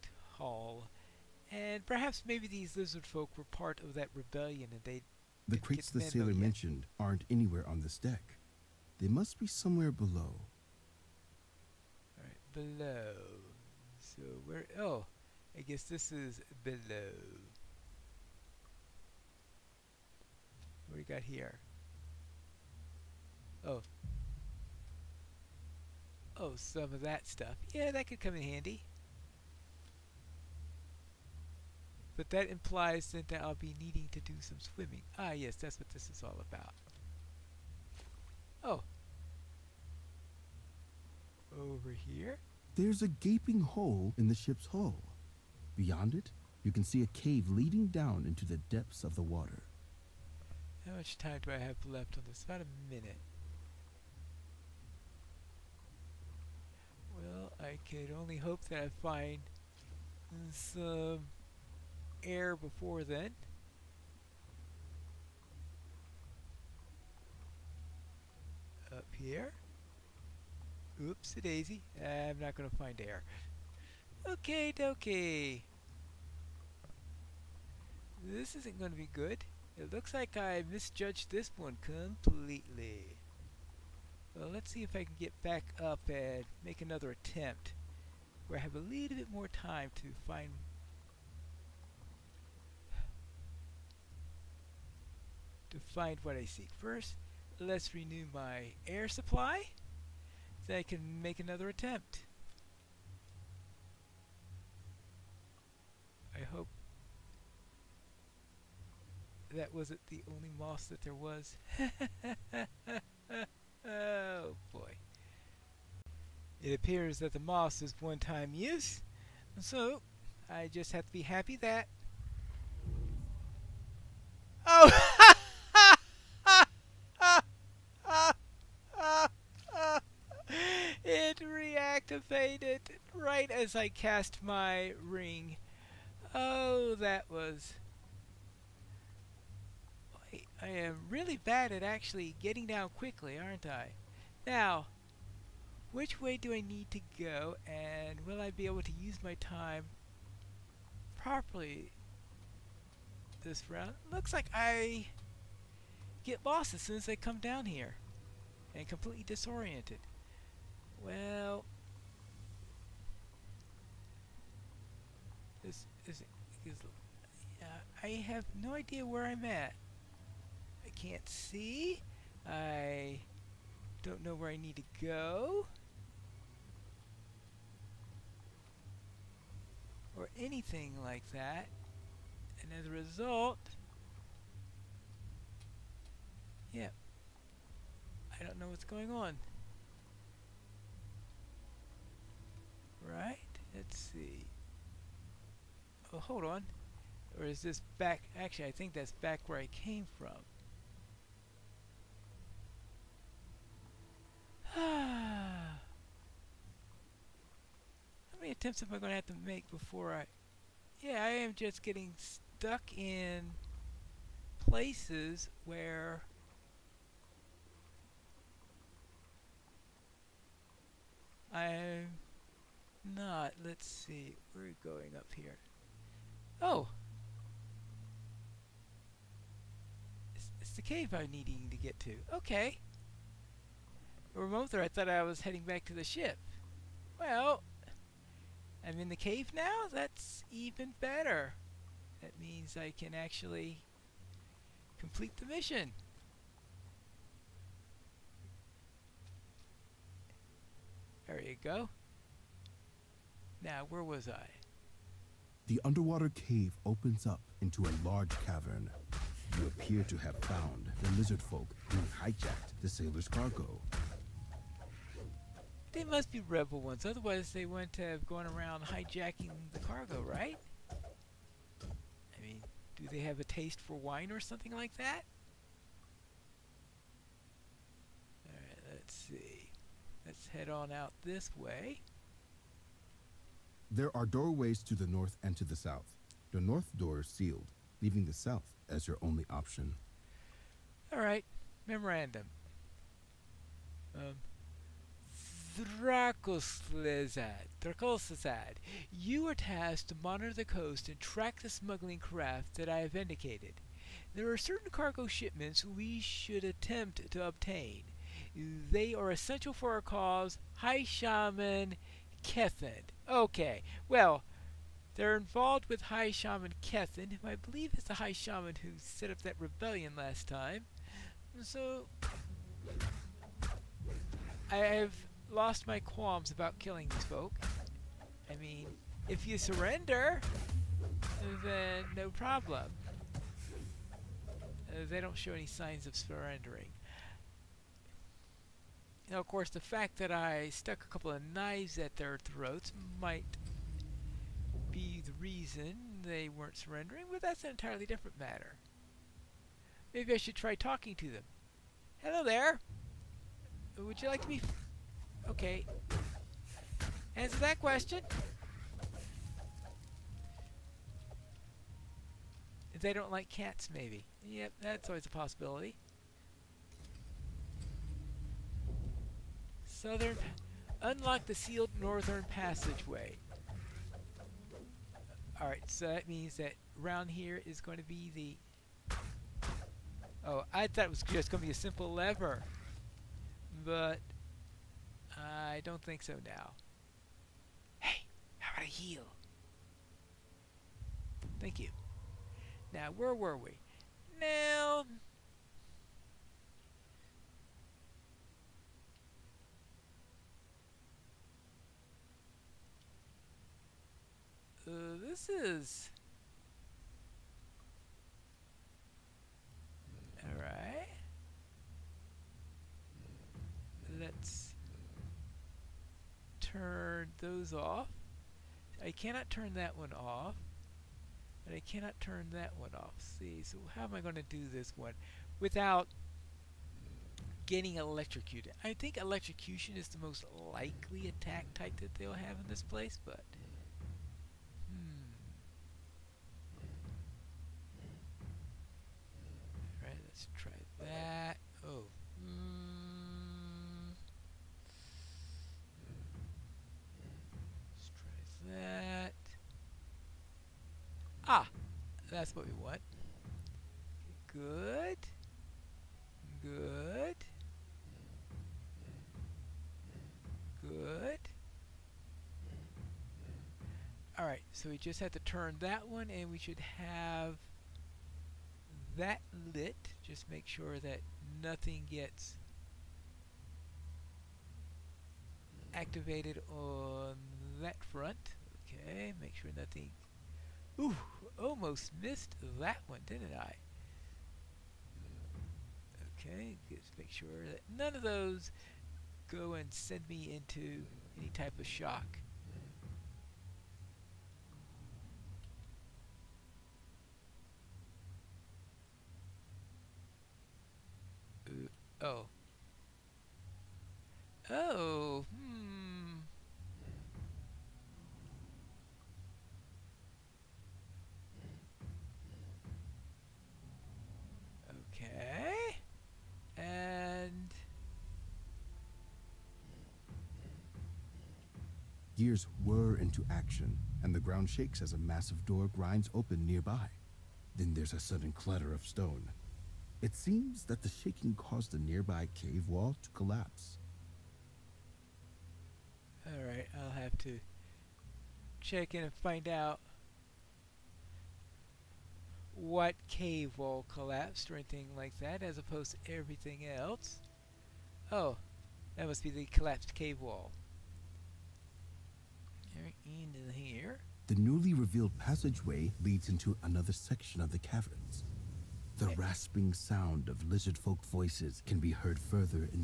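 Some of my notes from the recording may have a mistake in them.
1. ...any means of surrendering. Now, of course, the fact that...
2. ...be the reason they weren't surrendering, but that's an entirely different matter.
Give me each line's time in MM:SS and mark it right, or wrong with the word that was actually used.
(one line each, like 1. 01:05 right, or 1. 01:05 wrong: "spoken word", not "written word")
1. 05:35 wrong: "signs", not "means"
2. 05:44 right.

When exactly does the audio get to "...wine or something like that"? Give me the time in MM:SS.
04:33.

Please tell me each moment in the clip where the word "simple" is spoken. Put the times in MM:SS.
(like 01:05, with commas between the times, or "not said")
06:21.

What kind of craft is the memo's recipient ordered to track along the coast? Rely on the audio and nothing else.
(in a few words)
Smuggling craft.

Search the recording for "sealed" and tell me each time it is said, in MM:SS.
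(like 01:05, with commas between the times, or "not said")
04:47, 06:11.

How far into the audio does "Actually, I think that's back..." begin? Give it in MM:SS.
03:18.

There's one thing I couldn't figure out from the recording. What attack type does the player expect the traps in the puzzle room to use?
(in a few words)
Electrocution.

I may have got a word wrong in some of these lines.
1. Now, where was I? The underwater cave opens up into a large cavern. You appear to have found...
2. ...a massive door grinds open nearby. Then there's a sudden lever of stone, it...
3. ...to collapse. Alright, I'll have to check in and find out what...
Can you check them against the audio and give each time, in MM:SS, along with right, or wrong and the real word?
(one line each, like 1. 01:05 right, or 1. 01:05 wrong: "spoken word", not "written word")
1. 04:13 right
2. 08:45 wrong: "clatter", not "lever"
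3. 08:53 right.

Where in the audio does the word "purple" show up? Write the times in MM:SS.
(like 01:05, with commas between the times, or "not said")
not said.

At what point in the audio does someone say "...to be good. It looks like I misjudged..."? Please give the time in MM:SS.
01:18.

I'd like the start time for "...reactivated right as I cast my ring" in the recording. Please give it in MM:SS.
02:11.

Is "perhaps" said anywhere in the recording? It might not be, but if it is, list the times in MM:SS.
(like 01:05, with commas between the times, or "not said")
00:01.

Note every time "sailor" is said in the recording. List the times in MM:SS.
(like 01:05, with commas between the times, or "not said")
00:06, 04:22.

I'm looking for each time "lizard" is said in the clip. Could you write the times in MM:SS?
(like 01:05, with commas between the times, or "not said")
00:02, 04:21, 09:20.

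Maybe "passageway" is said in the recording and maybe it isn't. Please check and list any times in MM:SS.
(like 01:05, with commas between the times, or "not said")
06:12, 09:15.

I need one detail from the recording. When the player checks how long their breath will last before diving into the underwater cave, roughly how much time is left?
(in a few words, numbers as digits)
About a minute.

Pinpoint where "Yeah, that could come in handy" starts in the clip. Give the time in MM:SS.
00:27.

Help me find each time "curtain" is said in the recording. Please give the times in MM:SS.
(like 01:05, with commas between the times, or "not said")
not said.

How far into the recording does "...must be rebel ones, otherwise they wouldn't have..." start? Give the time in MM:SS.
04:26.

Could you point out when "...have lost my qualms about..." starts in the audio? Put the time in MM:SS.
05:24.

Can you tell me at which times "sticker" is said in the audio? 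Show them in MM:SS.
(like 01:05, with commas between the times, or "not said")
not said.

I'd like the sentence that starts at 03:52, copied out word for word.
Okay remote I thought I was heading back to the ship.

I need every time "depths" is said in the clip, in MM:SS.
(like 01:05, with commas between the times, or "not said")
00:48.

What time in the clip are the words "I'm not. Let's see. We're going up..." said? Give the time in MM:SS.
03:41.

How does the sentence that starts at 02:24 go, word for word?
Now, which way do I need to go and will I be able to use my time properly this round?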